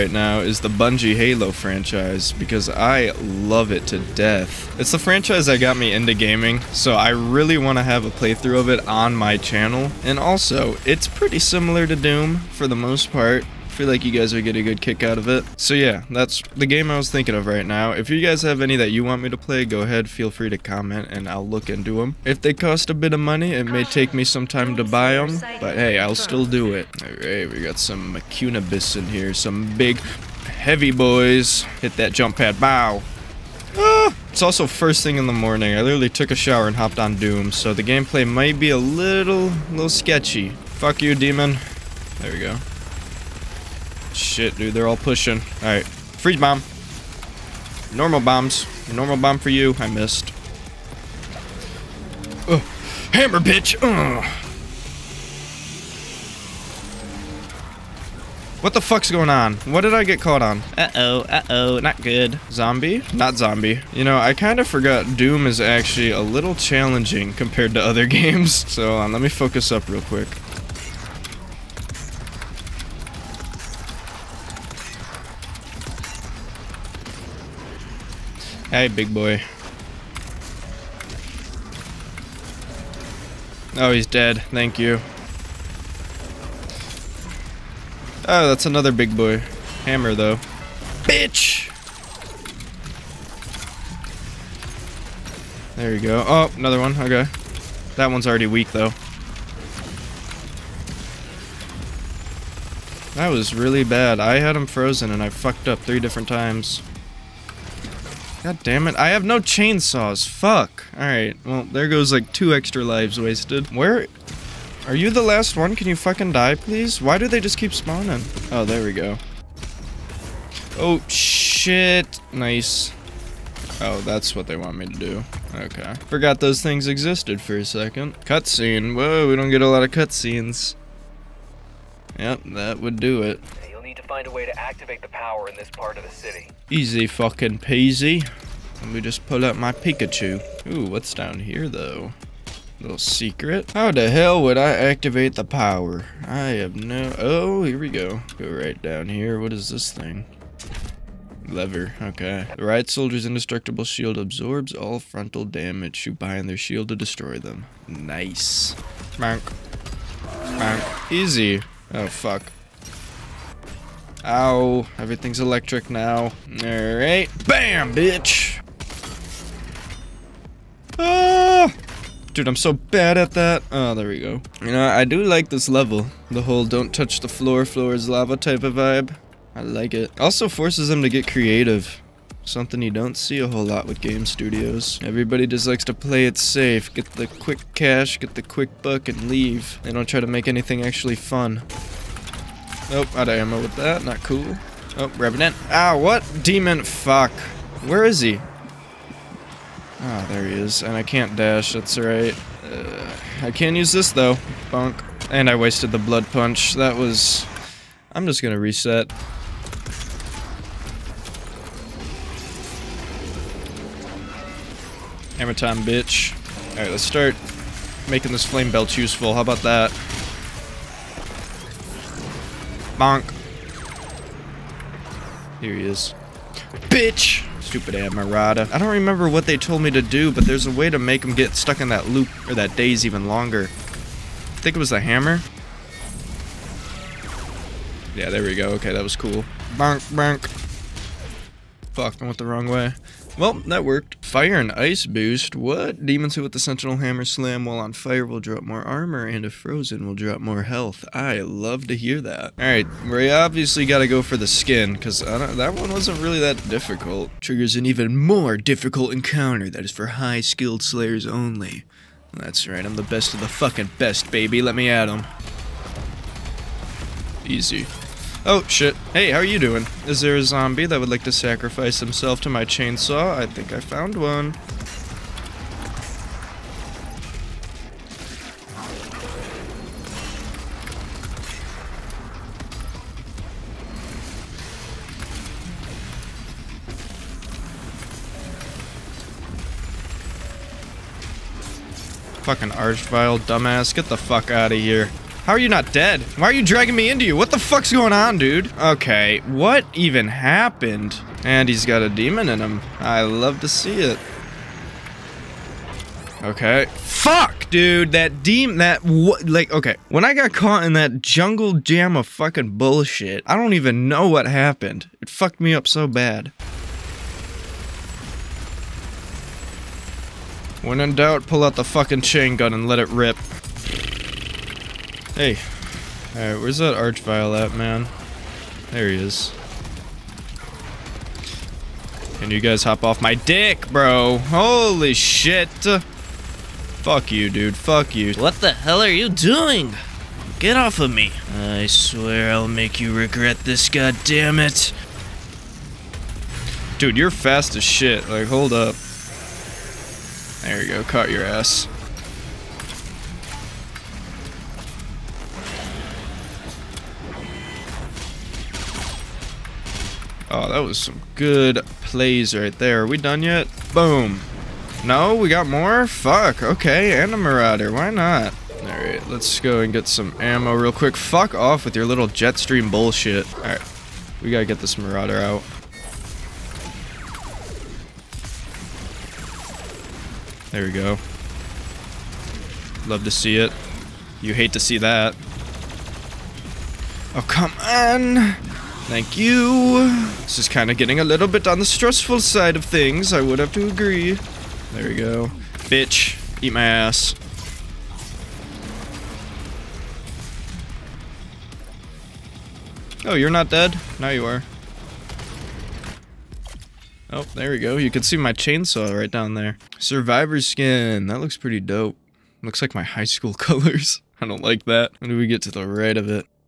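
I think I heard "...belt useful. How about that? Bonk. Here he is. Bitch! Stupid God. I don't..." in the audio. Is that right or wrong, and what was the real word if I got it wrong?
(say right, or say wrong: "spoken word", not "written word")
wrong: "Amarada", not "God".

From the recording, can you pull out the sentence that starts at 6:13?
Alright, we gotta get this Marauder out.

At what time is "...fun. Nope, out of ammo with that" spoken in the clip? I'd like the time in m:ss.
3:11.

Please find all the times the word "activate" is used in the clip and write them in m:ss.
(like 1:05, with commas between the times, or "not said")
2:14, 2:24.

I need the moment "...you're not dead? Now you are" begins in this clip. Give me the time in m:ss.
6:43.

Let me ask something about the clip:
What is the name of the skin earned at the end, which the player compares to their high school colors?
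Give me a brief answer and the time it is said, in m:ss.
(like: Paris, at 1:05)
Survivor, at 6:49.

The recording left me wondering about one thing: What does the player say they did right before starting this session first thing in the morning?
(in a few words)
took a shower.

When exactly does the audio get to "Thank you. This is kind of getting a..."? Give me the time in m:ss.
6:29.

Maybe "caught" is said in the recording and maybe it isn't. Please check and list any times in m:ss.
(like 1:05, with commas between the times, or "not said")
1:00, 5:10, 5:51.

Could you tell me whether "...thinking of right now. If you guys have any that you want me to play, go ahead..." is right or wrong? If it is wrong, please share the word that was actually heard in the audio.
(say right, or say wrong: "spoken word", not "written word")
right.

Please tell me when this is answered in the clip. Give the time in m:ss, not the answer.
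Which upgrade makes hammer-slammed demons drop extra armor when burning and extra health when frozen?
4:04.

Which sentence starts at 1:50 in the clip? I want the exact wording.
Alright, well, there goes like two extra lives wasted.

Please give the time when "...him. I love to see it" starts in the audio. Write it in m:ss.
5:02.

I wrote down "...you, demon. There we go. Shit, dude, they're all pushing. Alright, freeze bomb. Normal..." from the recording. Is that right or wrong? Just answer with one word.
right.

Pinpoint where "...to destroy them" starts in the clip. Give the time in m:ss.
2:36.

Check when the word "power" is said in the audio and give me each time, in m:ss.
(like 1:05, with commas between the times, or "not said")
2:15, 2:25.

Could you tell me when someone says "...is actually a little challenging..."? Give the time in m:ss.
1:05.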